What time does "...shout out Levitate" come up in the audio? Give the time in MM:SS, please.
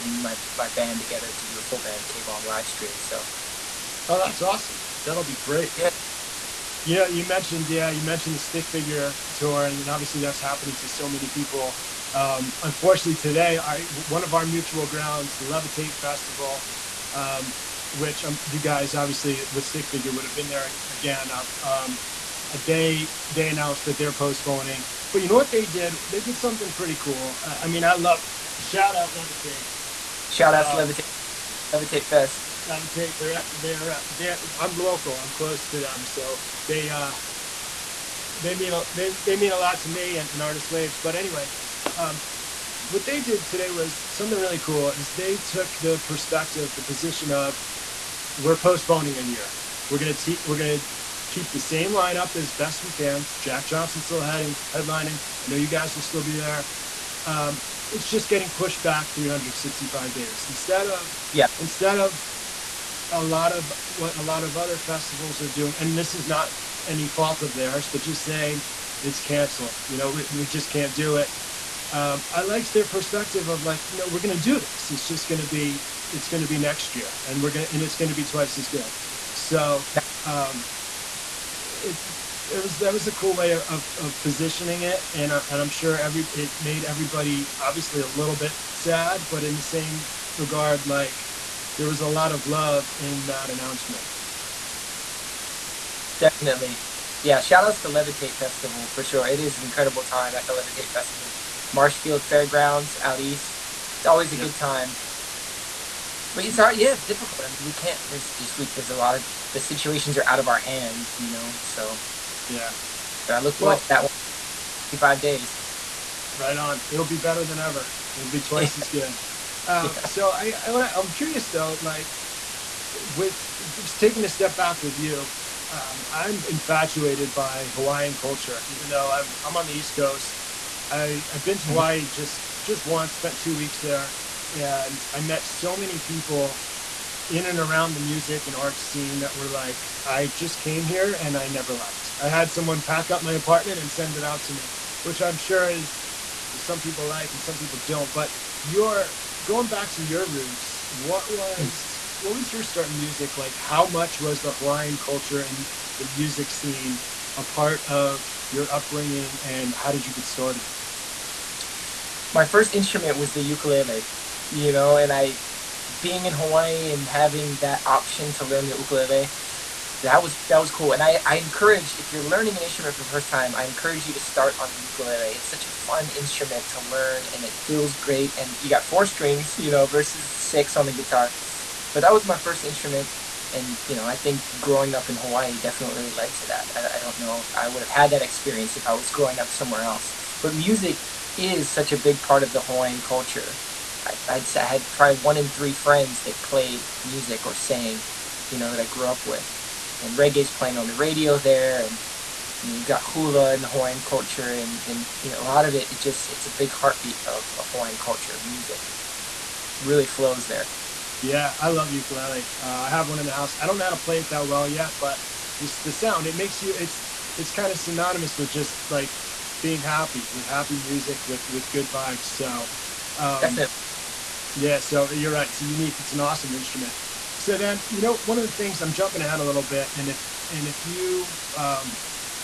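00:28.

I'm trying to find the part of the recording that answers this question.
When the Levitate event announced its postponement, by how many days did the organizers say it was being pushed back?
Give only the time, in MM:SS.
00:59.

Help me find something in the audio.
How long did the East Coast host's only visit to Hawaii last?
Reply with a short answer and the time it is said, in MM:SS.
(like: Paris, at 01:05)
2 weeks, at 02:13.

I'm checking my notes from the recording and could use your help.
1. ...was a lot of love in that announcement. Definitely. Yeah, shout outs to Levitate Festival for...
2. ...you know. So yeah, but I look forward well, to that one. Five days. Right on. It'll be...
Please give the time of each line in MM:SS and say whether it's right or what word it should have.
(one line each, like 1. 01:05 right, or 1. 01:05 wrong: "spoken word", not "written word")
1. 01:31 right
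2. 01:51 right.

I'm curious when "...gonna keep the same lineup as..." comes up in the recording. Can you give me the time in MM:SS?
00:50.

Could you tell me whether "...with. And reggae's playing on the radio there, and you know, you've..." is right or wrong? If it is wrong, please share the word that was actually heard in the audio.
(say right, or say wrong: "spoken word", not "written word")
right.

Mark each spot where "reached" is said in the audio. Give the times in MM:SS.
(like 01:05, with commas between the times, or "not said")
not said.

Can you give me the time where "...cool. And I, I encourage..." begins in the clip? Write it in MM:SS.
02:50.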